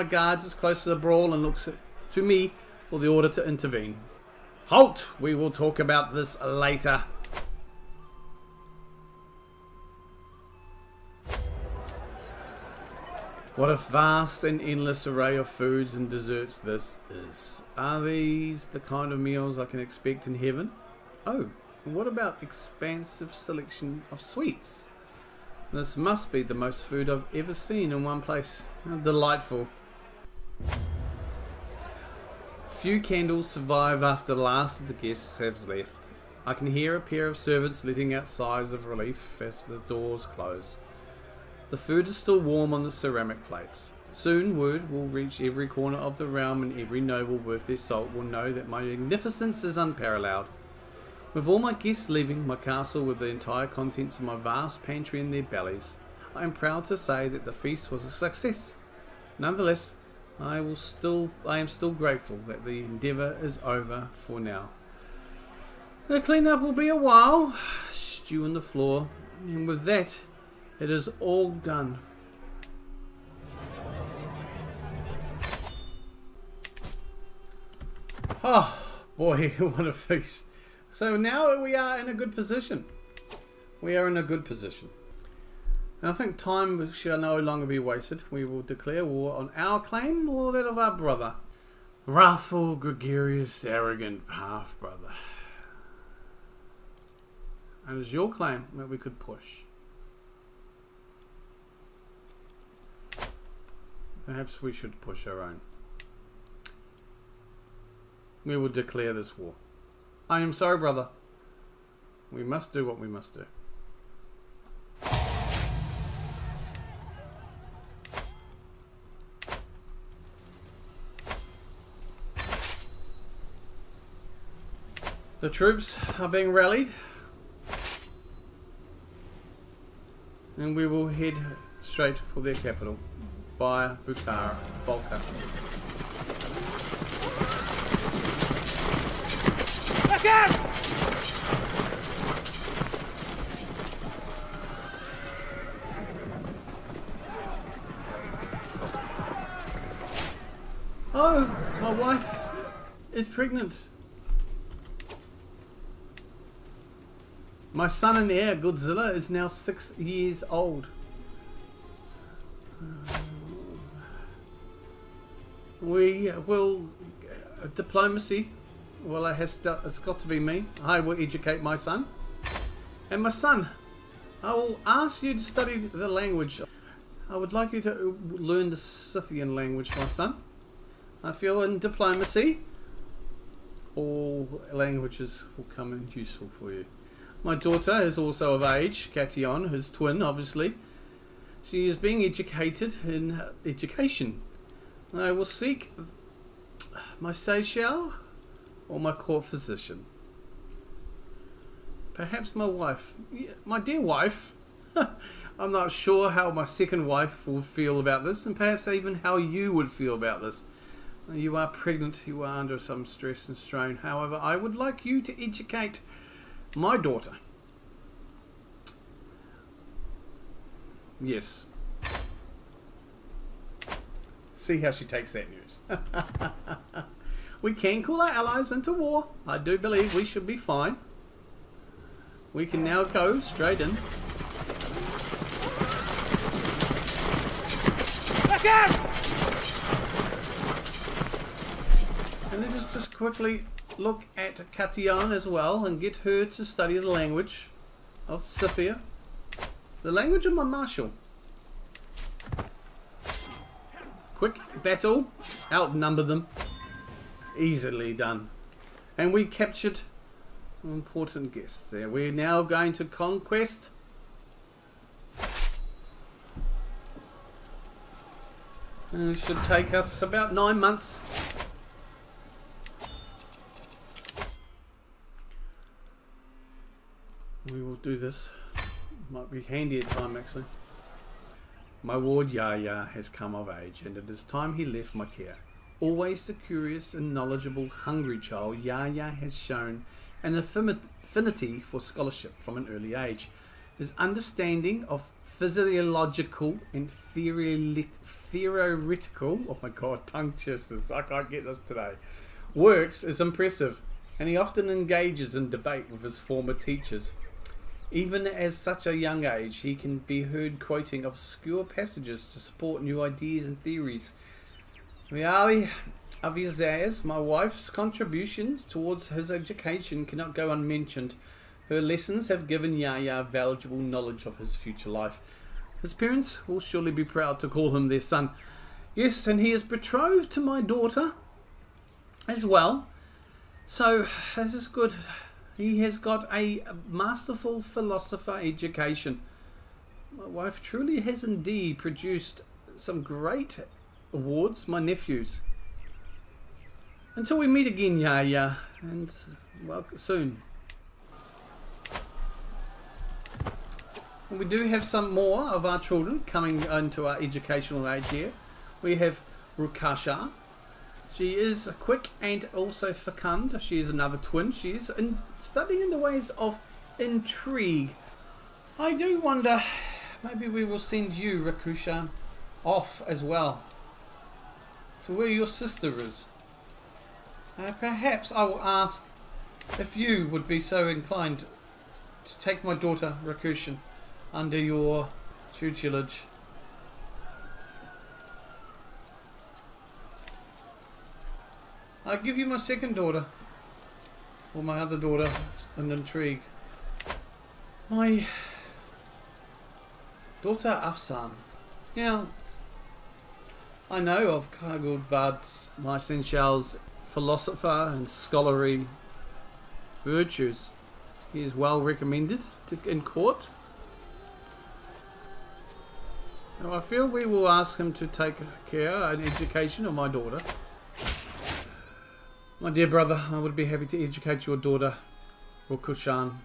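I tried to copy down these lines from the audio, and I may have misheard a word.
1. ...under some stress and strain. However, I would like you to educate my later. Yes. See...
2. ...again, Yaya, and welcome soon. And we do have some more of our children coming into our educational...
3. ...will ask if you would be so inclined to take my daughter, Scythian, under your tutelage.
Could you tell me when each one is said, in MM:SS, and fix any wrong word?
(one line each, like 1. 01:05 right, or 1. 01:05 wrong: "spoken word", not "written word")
1. 03:32 wrong: "daughter", not "later"
2. 05:47 right
3. 06:18 wrong: "Rakushin", not "Scythian".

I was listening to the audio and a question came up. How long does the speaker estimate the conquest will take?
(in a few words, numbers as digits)
Nine months.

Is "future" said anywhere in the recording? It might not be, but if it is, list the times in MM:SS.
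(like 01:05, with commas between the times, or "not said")
05:24.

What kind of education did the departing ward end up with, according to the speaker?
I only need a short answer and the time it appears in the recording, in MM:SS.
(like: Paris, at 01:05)
Masterful philosopher, at 05:37.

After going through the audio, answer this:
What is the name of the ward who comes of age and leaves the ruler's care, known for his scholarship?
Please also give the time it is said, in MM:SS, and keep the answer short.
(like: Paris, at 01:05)
Yahya, at 04:48.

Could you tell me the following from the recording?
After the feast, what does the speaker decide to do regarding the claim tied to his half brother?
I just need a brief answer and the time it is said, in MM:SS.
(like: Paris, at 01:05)
Declare war, at 01:28.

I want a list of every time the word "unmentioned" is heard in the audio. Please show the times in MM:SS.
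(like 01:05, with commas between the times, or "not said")
05:20.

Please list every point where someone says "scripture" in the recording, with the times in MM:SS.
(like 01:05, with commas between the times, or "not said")
not said.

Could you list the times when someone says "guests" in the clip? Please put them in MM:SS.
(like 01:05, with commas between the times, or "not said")
00:34, 00:51, 04:21.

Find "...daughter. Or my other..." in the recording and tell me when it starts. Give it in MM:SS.
06:33.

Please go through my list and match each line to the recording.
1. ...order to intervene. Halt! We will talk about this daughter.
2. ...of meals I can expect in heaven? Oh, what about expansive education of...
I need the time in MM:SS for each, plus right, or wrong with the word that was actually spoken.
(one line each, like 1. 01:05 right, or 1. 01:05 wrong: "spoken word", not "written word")
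1. 00:03 wrong: "later", not "daughter"
2. 00:19 wrong: "selection", not "education".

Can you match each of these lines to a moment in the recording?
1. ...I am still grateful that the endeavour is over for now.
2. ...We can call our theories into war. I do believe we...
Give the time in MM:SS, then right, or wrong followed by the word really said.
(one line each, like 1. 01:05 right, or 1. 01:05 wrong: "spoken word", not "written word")
1. 01:01 right
2. 03:47 wrong: "allies", not "theories".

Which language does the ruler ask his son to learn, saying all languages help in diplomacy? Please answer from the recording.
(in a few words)
Scythian.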